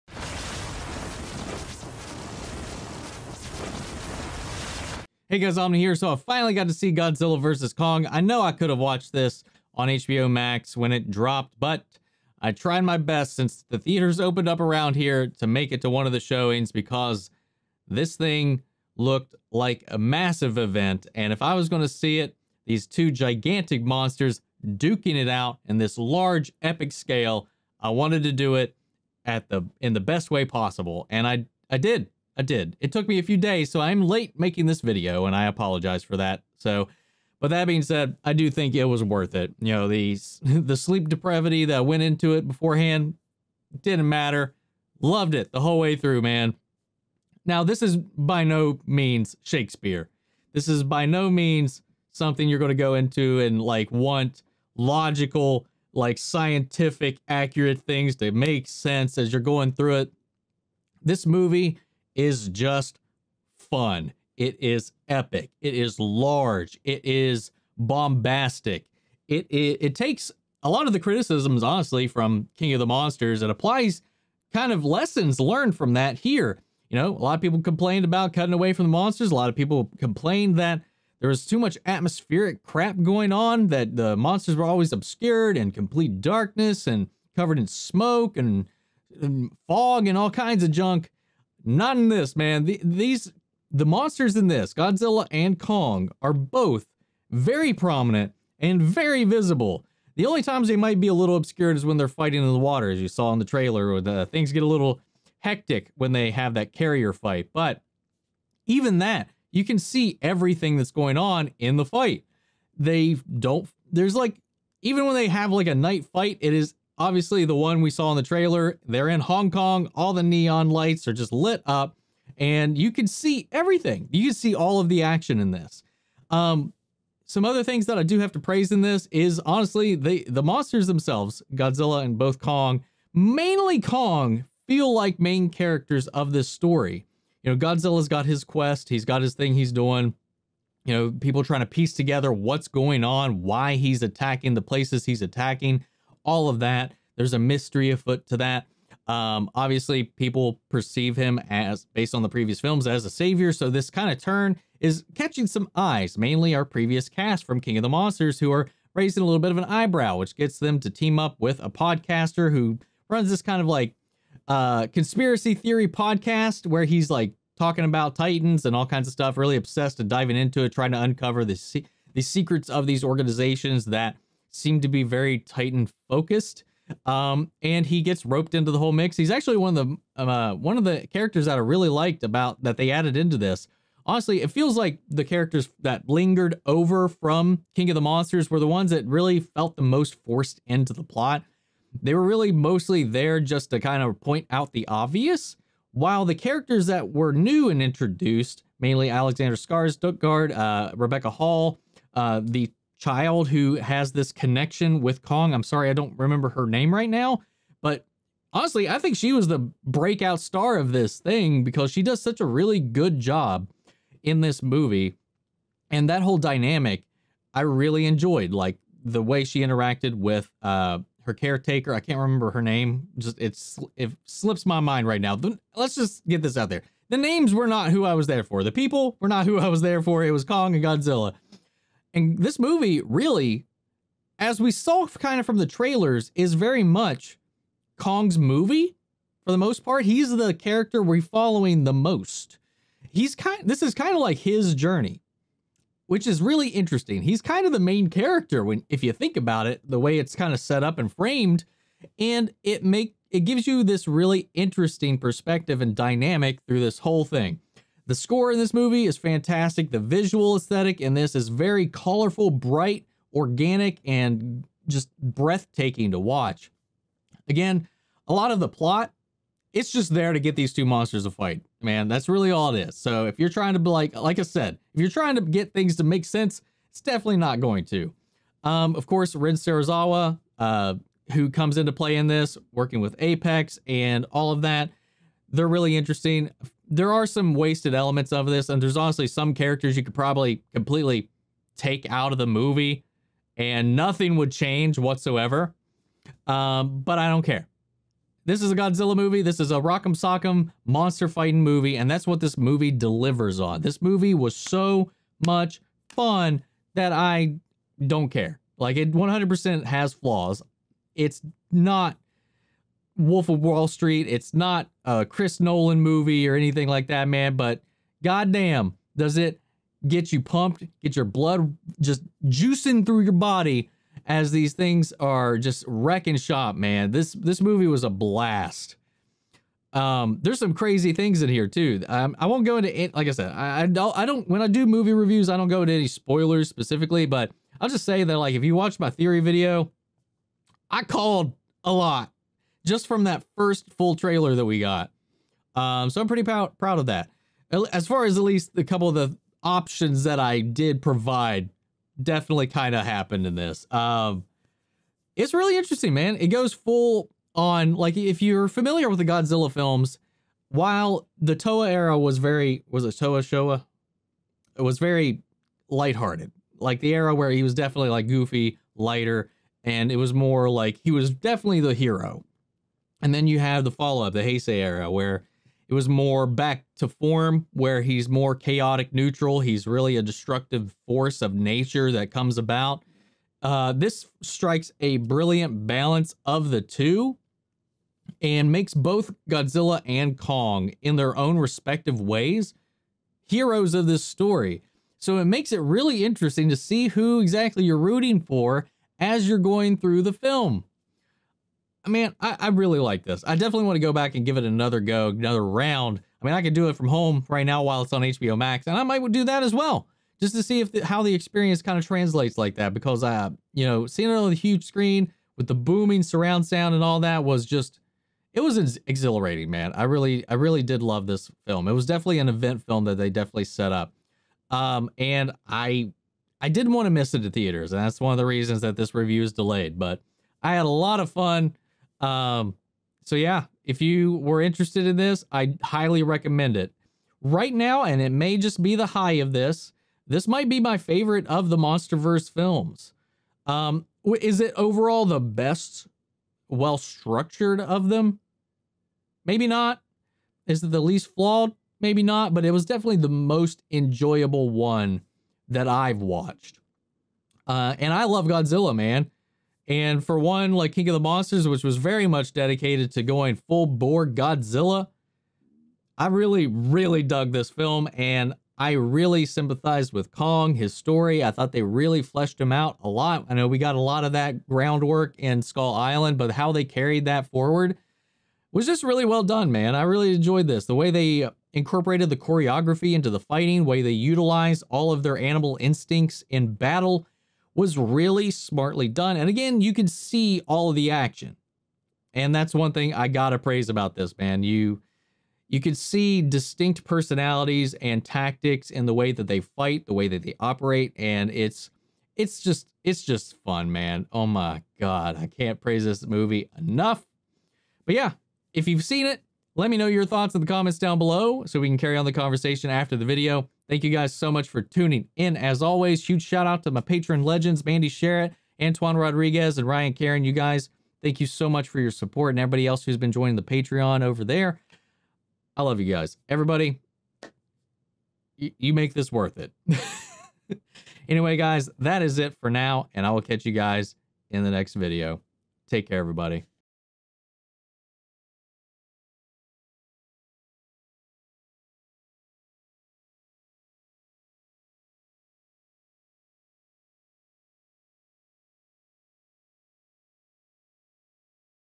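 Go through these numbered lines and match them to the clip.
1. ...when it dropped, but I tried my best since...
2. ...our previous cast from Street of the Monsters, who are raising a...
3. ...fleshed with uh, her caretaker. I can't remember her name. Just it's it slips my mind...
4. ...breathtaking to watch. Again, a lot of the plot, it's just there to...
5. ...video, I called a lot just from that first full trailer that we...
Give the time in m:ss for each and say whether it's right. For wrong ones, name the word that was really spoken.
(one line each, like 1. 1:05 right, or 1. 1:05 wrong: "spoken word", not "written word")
1. 0:10 right
2. 2:36 wrong: "King", not "Street"
3. 3:39 wrong: "interacted", not "fleshed"
4. 4:25 right
5. 5:39 right.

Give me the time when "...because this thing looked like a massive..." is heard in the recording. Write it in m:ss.
0:16.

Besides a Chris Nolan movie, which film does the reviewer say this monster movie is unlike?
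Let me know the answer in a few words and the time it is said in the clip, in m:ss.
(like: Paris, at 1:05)
Wolf of Wall Street, at 5:13.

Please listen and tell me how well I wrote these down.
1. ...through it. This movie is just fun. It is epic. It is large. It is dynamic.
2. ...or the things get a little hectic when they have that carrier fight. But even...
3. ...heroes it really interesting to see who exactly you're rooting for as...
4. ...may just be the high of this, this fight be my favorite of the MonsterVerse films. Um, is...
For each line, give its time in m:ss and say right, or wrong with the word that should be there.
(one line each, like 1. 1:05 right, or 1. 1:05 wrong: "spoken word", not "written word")
1. 0:59 wrong: "bombastic", not "dynamic"
2. 1:43 right
3. 6:35 wrong: "makes", not "heroes"
4. 7:18 wrong: "might", not "fight".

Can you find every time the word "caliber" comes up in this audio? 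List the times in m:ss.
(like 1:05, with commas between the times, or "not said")
not said.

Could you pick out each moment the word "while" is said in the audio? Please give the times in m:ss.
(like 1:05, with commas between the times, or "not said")
3:15, 6:00, 6:47.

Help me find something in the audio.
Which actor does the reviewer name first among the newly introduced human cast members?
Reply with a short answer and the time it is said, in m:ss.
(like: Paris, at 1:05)
Alexander Skarsgård, at 3:19.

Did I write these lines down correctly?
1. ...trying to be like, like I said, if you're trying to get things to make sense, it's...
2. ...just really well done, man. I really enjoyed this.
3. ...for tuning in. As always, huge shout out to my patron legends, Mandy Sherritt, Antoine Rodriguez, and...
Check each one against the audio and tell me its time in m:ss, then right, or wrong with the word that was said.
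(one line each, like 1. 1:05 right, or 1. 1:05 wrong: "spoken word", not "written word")
1. 4:33 right
2. 7:58 right
3. 8:34 right.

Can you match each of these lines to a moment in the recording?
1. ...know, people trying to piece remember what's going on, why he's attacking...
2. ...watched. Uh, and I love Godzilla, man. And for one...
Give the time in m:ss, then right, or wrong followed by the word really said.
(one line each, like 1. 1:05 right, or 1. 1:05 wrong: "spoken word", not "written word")
1. 2:20 wrong: "together", not "remember"
2. 7:36 right.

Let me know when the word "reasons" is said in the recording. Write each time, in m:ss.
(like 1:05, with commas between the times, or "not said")
7:08.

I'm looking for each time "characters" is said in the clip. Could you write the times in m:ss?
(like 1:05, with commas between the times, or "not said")
2:15, 3:01, 3:05, 3:16, 4:00, 4:08, 4:49.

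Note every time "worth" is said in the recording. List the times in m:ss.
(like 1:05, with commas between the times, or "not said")
0:39, 8:49.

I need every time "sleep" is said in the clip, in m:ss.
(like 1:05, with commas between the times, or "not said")
0:40.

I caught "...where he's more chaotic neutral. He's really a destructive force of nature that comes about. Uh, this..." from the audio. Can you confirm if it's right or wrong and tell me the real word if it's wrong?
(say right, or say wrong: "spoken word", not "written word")
right.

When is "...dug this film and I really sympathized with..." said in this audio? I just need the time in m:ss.
7:47.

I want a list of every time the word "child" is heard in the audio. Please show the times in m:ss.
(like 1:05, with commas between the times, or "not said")
3:23.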